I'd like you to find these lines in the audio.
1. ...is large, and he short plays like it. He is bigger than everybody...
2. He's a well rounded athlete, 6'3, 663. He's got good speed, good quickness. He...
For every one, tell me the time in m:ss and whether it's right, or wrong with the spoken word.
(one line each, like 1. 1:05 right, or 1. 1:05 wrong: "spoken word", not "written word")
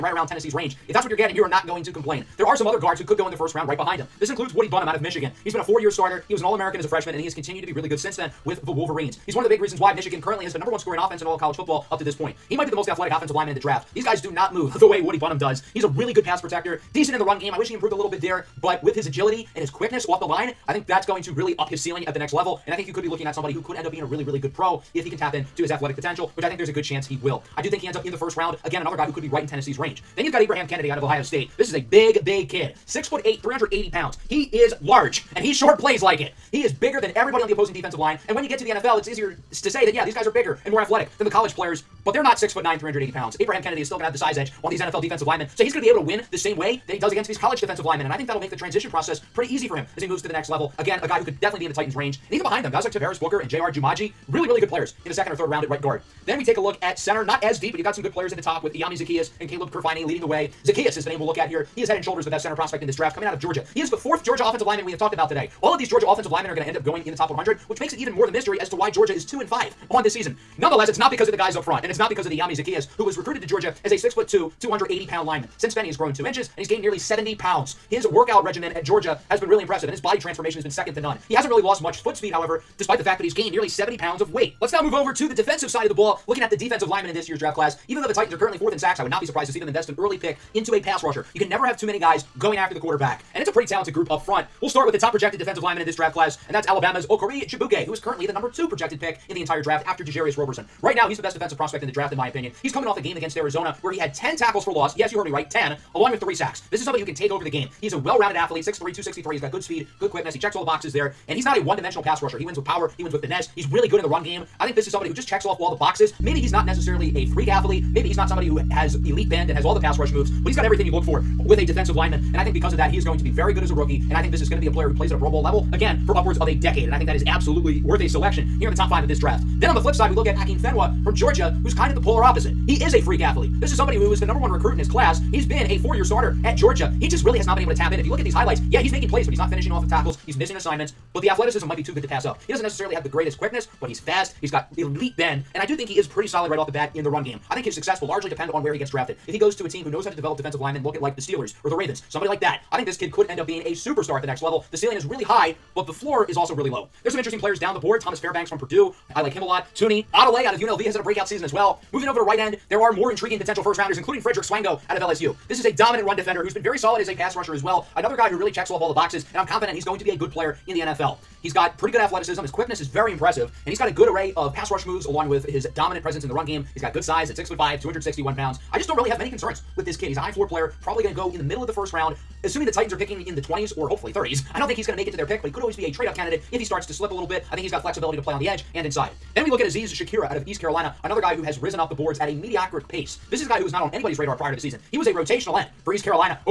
1. 0:34 right
2. 1:47 wrong: "263", not "663".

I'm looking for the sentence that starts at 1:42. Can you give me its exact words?
He's coming off a game against Arizona where he had 10 tackles for loss.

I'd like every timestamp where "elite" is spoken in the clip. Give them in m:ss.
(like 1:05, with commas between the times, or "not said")
1:59, 2:24.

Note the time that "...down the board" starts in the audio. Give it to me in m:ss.
2:37.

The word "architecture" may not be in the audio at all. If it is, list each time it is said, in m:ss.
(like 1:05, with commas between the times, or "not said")
not said.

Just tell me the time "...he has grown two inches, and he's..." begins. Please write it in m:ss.
1:15.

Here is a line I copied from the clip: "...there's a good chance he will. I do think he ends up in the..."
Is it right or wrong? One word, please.
right.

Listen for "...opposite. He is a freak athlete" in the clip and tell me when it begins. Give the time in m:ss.
2:12.